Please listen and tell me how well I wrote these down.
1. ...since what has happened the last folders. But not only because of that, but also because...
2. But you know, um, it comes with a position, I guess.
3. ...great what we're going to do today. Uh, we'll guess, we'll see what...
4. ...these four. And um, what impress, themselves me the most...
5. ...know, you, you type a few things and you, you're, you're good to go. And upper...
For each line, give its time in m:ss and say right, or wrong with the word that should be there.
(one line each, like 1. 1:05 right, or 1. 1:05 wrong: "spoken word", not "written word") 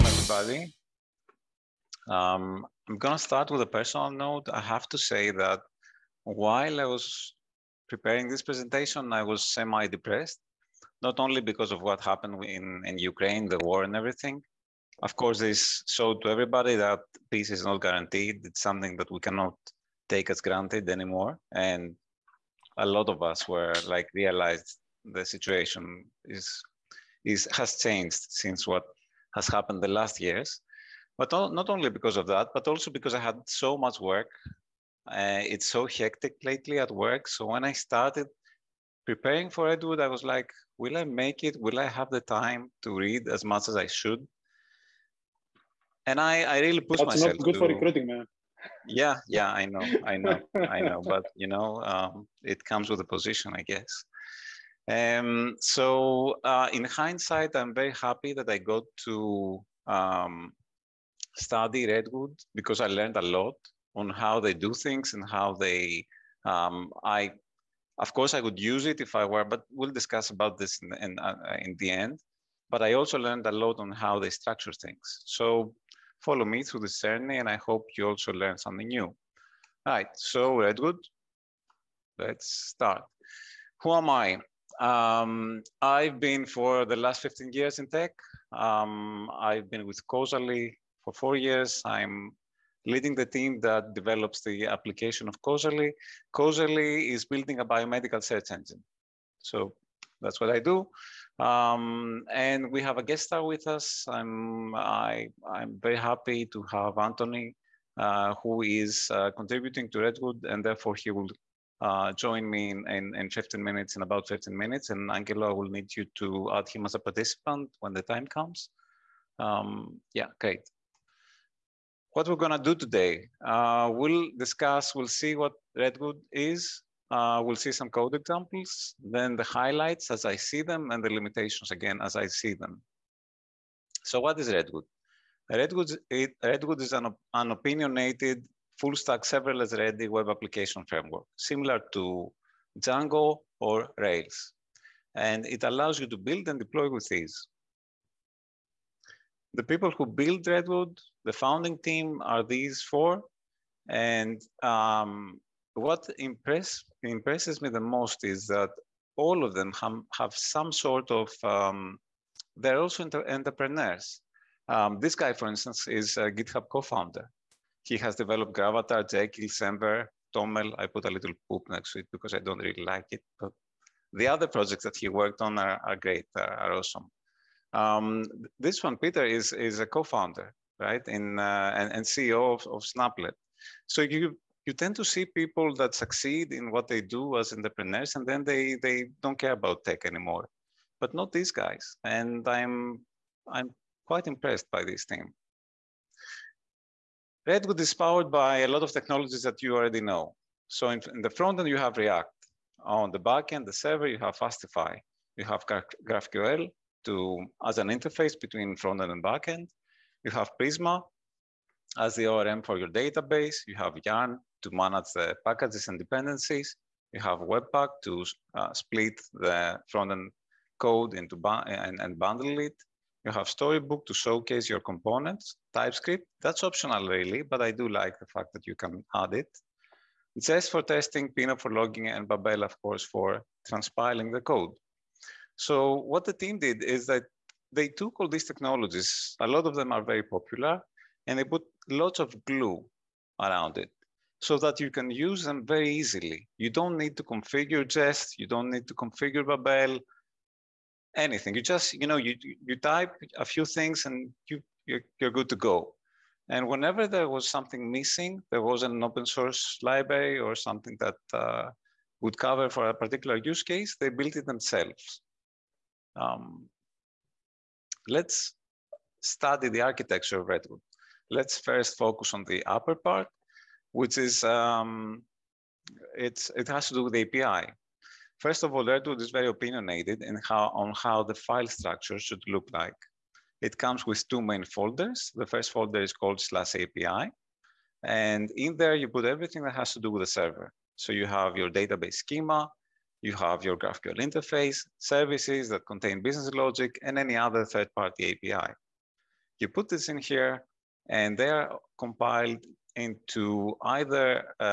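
1. 0:28 wrong: "years", not "folders"
2. 0:51 right
3. 2:00 wrong: "discuss", not "guess"
4. 2:32 wrong: "impresses", not "themselves"
5. 4:12 wrong: "whenever", not "upper".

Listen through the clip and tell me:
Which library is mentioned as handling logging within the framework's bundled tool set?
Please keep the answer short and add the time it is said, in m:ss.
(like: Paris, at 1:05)
Pino, at 3:51.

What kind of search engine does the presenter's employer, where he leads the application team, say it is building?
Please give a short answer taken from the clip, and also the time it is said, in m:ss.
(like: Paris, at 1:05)
biomedical, at 1:37.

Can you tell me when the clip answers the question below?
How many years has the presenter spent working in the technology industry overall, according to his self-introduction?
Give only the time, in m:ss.
1:27.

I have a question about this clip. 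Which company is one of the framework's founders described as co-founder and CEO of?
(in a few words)
Snaplet.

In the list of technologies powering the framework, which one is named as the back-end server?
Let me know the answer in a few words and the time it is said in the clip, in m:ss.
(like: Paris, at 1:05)
Fastify, at 3:24.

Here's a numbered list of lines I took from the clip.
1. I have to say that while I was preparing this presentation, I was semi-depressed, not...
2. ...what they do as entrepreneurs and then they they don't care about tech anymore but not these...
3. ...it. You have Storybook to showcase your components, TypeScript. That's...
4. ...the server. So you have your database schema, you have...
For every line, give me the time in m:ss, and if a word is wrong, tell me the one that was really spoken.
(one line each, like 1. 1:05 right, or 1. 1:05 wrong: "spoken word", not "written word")
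1. 0:04 right
2. 3:06 right
3. 3:42 right
4. 4:50 right.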